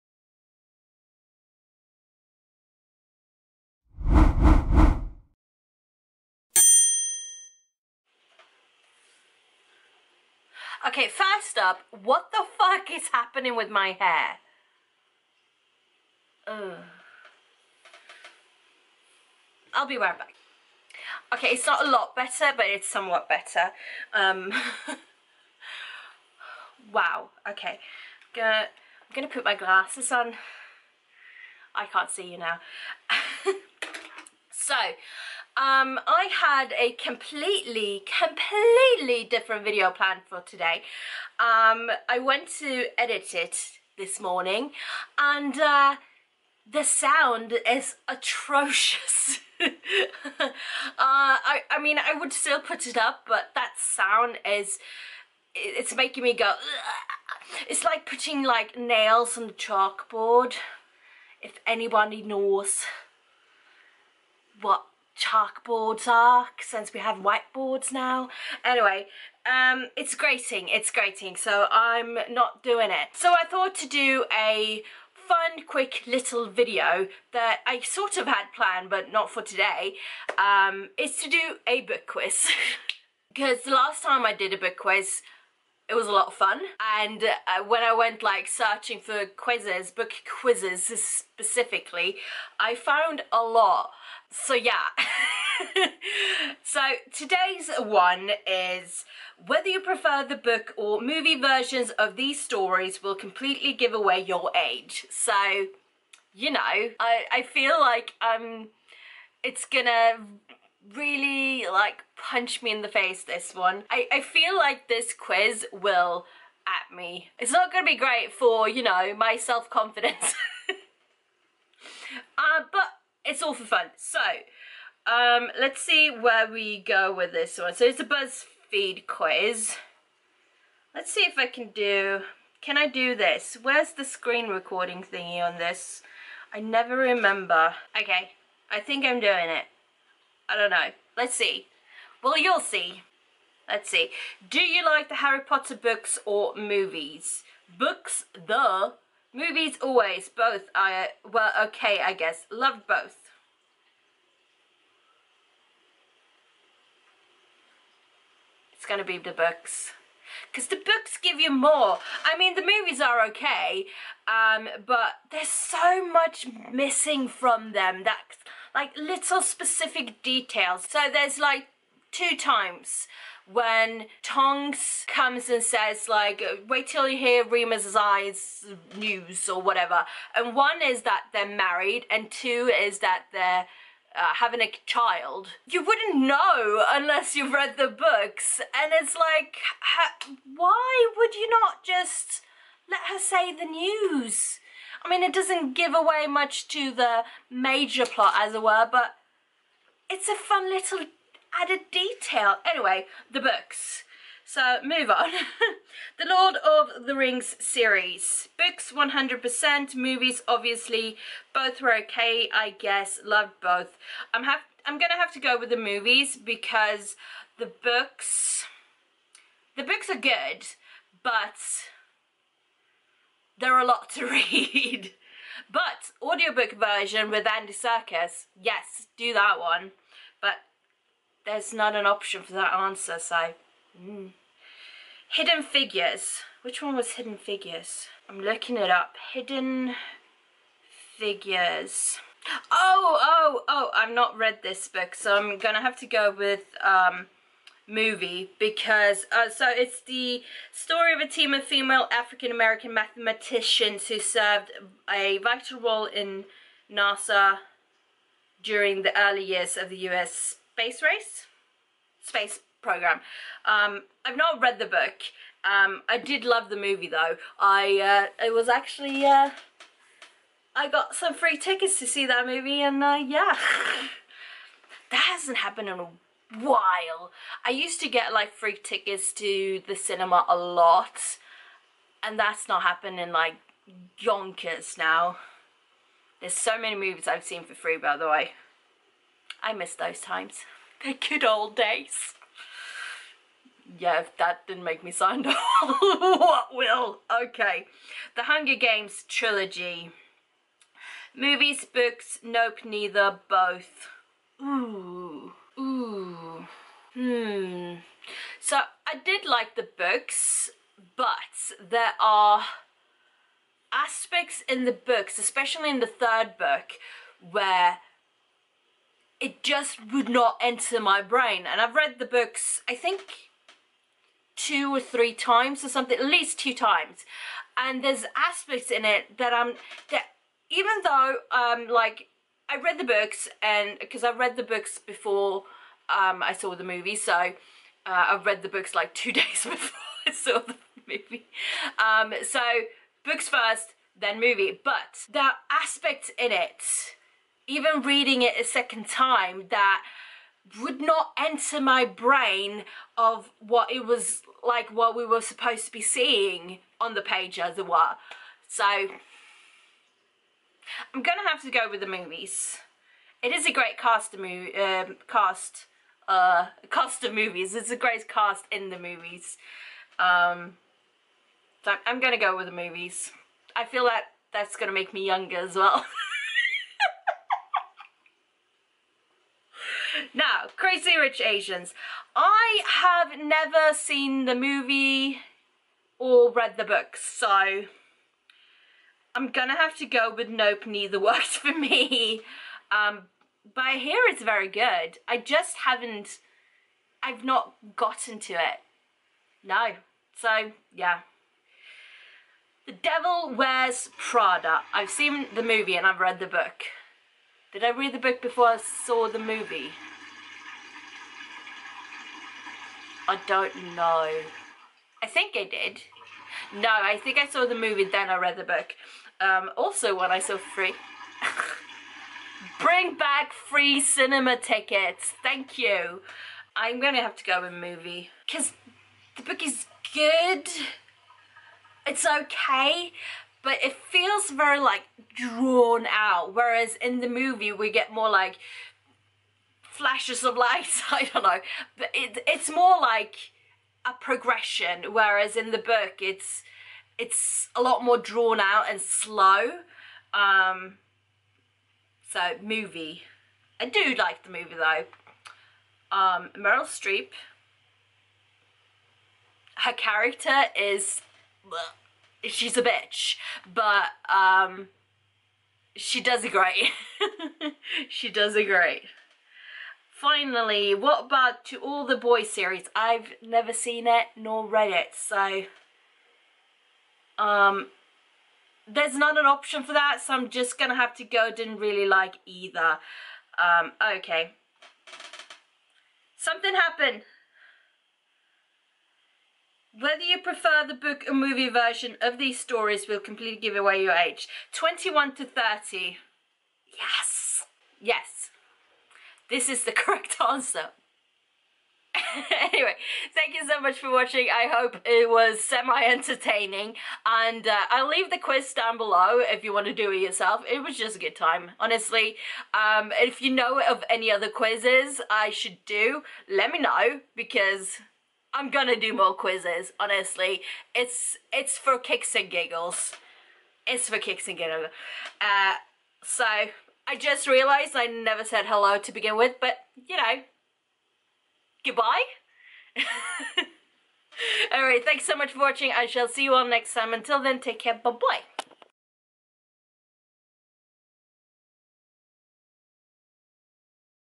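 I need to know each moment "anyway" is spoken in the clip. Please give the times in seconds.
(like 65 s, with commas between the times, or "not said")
68 s, 202 s, 502 s.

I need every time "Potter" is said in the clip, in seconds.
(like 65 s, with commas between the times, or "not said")
145 s.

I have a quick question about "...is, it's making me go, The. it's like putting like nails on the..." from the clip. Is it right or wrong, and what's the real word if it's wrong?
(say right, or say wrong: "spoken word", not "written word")
wrong: "Ugh", not "The".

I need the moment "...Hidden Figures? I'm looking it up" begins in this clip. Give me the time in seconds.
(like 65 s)
237 s.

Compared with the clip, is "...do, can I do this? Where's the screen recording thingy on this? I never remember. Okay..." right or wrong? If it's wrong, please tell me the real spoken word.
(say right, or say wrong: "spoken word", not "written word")
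right.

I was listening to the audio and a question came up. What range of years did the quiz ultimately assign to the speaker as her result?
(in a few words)
21 to 30.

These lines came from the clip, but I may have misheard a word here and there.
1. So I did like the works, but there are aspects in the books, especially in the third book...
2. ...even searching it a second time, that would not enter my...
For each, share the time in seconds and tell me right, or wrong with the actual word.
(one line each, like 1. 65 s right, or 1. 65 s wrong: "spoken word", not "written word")
1. 308 s wrong: "books", not "works"
2. 347 s wrong: "reading", not "searching".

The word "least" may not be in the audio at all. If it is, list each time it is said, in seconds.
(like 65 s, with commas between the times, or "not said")
326 s.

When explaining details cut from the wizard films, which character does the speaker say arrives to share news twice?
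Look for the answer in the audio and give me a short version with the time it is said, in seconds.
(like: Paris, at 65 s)
Tonks, at 174 s.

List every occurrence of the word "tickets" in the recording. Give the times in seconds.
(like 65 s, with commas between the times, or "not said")
271 s, 278 s, 424 s.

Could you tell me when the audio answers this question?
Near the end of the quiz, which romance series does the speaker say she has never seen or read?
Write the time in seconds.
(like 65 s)
471 s.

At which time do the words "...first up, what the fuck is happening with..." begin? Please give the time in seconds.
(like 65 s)
11 s.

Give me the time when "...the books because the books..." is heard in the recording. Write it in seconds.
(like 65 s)
159 s.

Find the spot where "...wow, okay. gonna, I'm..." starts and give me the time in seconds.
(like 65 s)
26 s.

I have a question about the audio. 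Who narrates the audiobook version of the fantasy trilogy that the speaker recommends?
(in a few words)
Andy Serkis.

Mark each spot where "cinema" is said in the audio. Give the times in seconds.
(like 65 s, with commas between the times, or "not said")
279 s, 424 s.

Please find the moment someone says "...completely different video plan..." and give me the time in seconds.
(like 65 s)
38 s.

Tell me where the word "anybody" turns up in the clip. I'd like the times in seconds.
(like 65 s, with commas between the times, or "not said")
61 s.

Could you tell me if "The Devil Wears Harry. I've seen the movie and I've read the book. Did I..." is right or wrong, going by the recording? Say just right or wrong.
wrong.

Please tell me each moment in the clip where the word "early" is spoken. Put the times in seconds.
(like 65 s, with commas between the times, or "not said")
259 s.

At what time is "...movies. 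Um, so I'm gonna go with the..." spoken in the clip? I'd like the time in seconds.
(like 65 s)
368 s.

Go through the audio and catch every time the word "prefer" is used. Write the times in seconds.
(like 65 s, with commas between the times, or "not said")
99 s, 490 s.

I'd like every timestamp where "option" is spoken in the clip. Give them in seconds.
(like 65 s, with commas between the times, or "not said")
232 s, 479 s.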